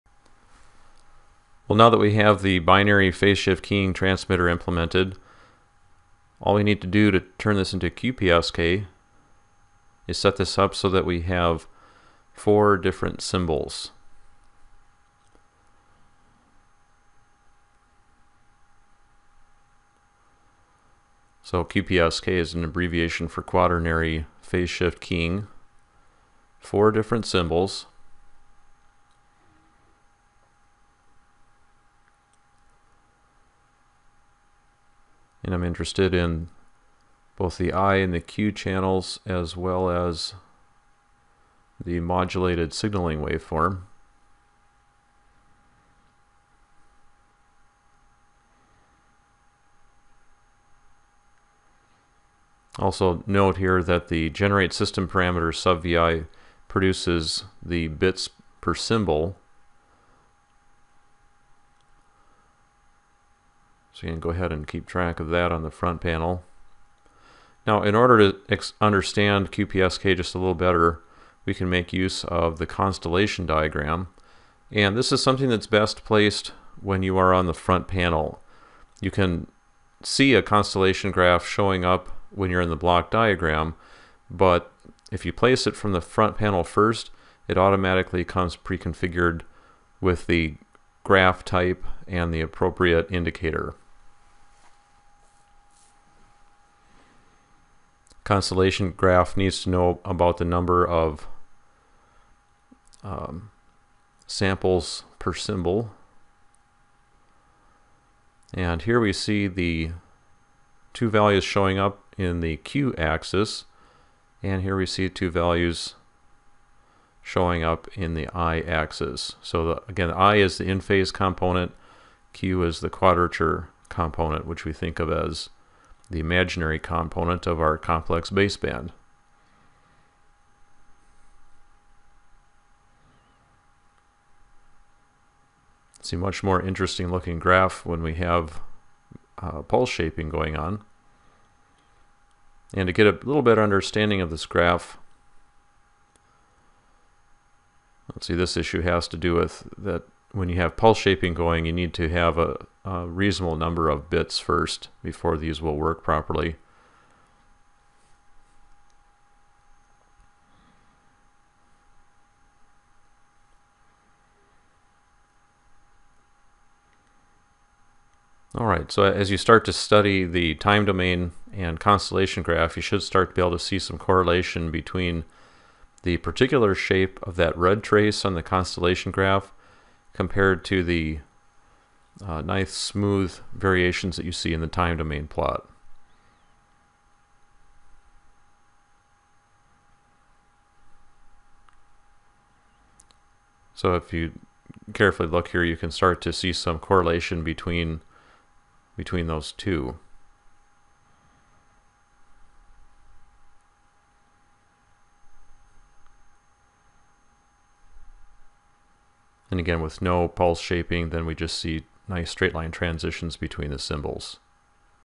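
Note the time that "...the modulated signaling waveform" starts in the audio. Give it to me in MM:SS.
00:41.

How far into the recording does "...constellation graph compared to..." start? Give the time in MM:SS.
02:58.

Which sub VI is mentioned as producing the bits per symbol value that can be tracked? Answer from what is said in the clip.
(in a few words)
Generate system parameter.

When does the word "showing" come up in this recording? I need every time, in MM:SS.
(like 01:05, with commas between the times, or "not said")
01:21, 01:51, 01:57.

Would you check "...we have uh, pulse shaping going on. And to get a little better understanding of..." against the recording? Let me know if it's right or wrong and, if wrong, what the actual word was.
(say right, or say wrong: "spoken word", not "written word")
right.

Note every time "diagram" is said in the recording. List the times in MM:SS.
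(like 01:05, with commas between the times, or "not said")
01:13, 01:23.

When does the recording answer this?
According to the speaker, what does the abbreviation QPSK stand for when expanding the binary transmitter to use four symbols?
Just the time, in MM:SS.
00:23.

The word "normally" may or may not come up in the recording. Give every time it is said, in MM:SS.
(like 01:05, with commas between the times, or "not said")
not said.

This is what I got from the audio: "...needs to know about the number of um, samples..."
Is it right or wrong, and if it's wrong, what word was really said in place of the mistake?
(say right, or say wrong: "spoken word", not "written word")
right.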